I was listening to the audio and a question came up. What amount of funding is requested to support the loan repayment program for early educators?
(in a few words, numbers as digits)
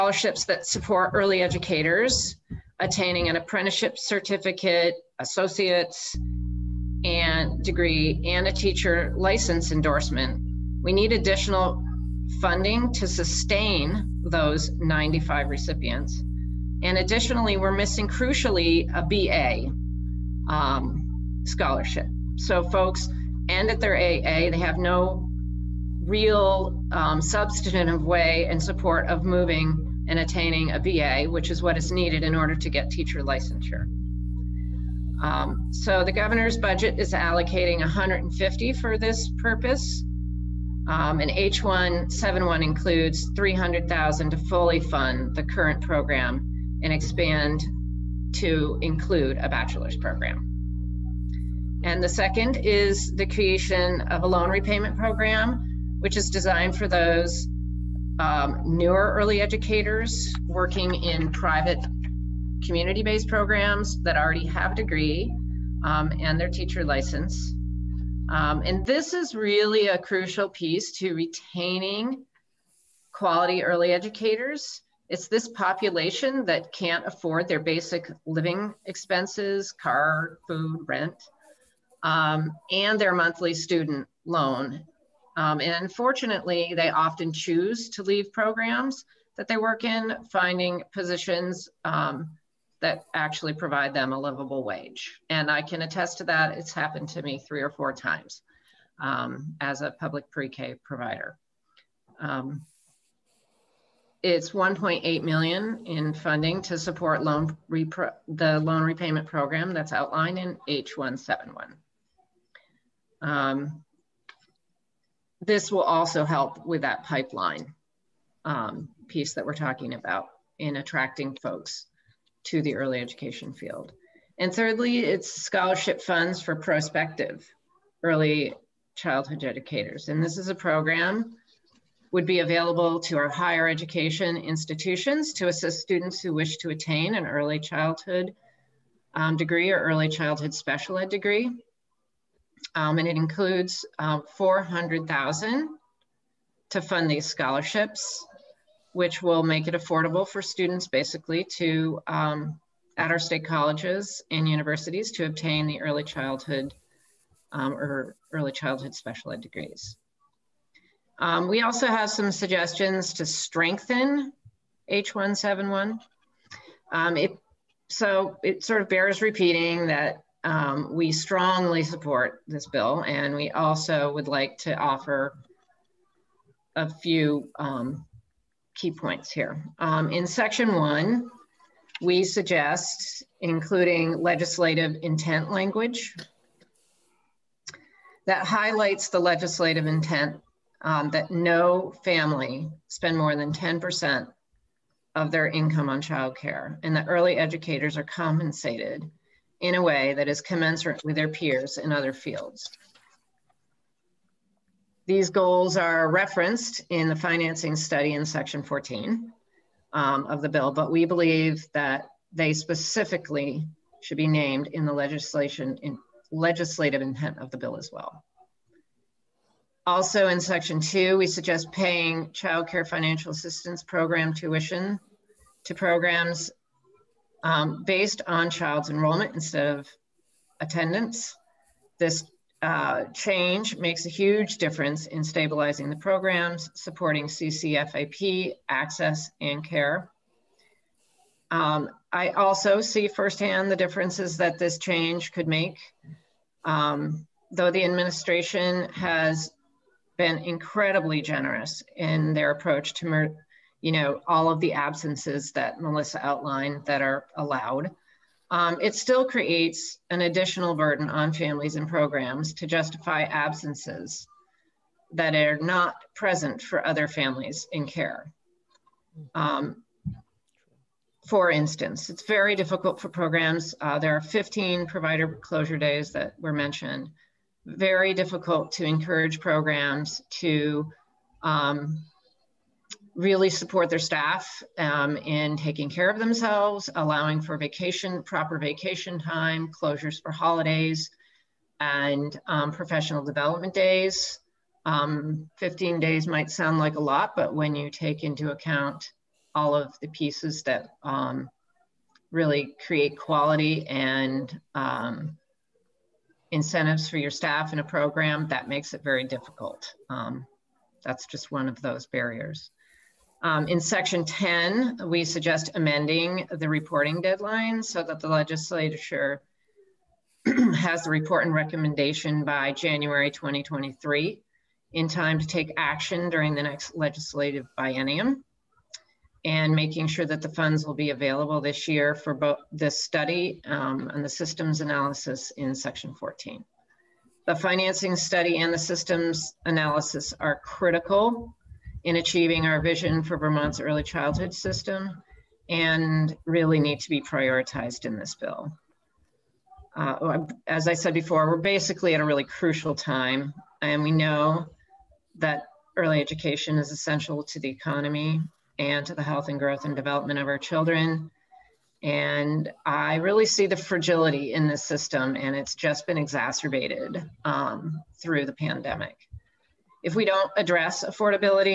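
$1.8 million.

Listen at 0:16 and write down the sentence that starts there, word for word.
And additionally, we're missing crucially a BA um, scholarship.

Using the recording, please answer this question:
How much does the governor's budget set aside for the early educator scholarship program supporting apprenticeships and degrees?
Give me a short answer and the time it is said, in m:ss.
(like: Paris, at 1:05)
150, at 0:37.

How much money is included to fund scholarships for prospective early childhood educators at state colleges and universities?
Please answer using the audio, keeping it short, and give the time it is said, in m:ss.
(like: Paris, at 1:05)
$400,000, at 2:24.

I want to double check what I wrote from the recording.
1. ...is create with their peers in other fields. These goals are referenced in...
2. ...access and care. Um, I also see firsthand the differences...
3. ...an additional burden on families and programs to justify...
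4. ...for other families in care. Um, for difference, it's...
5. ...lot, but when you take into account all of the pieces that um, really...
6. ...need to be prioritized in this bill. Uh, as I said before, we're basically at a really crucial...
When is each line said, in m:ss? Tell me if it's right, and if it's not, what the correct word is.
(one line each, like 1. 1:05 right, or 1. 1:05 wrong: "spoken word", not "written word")
1. 3:20 wrong: "commensurate", not "create"
2. 3:58 right
3. 4:20 right
4. 4:26 wrong: "instance", not "difference"
5. 4:56 right
6. 5:46 right.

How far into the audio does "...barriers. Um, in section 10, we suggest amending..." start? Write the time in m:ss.
5:12.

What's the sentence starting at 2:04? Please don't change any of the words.
And thirdly, it's scholarship funds for prospective early childhood educators.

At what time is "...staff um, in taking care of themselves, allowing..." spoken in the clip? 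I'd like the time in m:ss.
4:43.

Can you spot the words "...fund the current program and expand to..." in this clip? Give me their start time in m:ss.
0:44.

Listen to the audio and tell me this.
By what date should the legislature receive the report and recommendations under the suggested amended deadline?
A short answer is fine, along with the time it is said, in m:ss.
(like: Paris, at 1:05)
January 2023, at 5:22.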